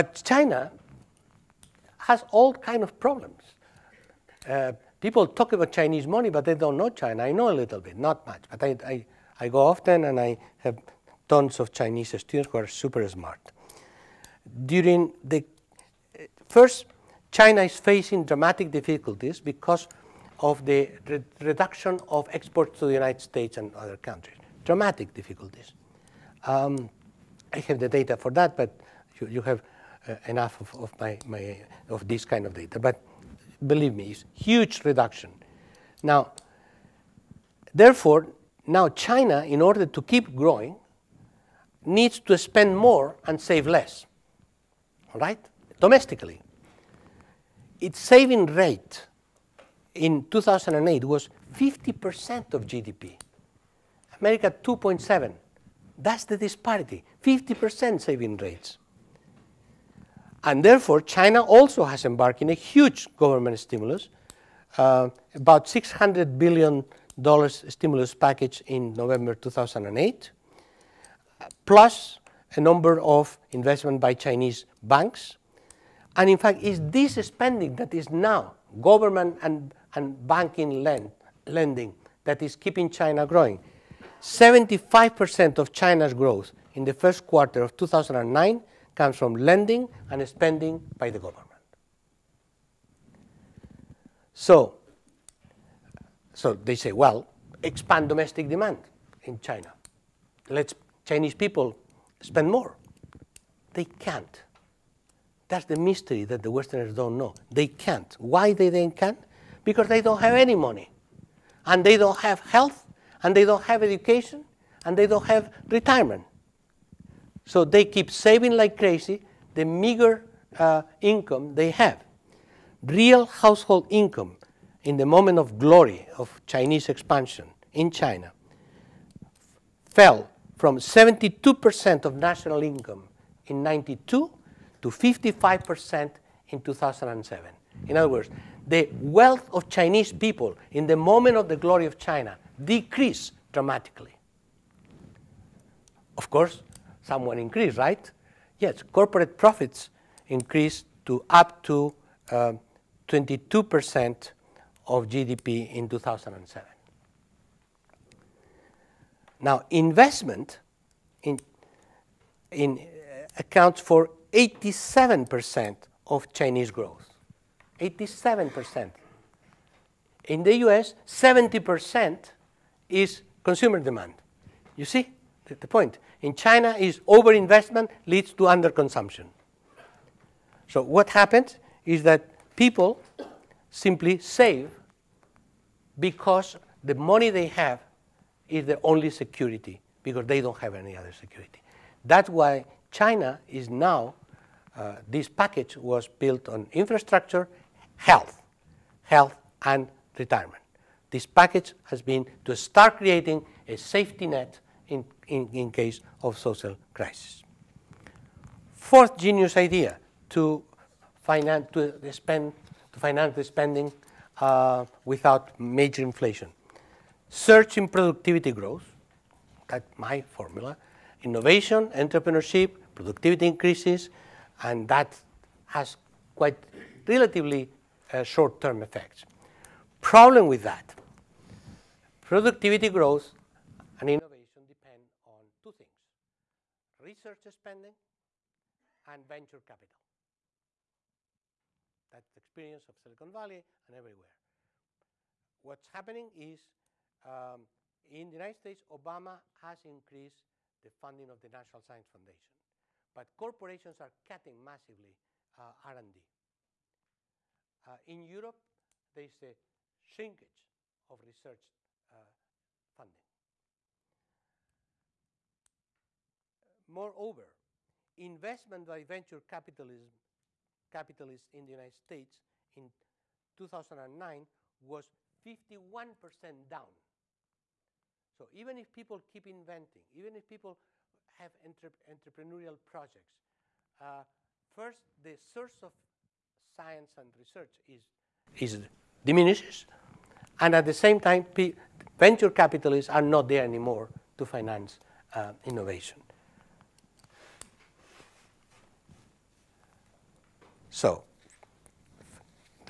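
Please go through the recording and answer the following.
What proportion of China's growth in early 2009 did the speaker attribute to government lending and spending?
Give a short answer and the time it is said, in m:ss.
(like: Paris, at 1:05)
75%, at 1:24.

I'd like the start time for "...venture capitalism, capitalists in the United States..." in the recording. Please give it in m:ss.
4:29.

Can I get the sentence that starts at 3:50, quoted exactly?
Problem with that, productivity growth and innovation depend on two things, research spending and venture capital.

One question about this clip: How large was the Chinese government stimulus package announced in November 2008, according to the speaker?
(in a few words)
$600 billion.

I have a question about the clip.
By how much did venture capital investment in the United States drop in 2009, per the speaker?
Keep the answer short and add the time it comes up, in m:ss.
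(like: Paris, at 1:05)
51%, at 4:35.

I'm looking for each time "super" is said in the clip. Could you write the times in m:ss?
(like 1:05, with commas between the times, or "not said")
0:12.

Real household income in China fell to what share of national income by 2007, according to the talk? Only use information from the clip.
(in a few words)
55%.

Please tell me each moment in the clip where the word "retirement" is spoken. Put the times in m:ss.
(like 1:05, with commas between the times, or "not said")
1:55, 3:20.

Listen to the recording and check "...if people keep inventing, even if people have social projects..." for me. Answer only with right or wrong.
wrong.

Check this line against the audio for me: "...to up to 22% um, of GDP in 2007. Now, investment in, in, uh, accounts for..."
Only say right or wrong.
right.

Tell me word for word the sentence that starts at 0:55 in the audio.
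That's the disparity, 50% saving rates.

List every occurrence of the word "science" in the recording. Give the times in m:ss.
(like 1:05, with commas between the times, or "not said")
4:11, 4:46.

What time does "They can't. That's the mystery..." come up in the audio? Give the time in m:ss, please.
1:43.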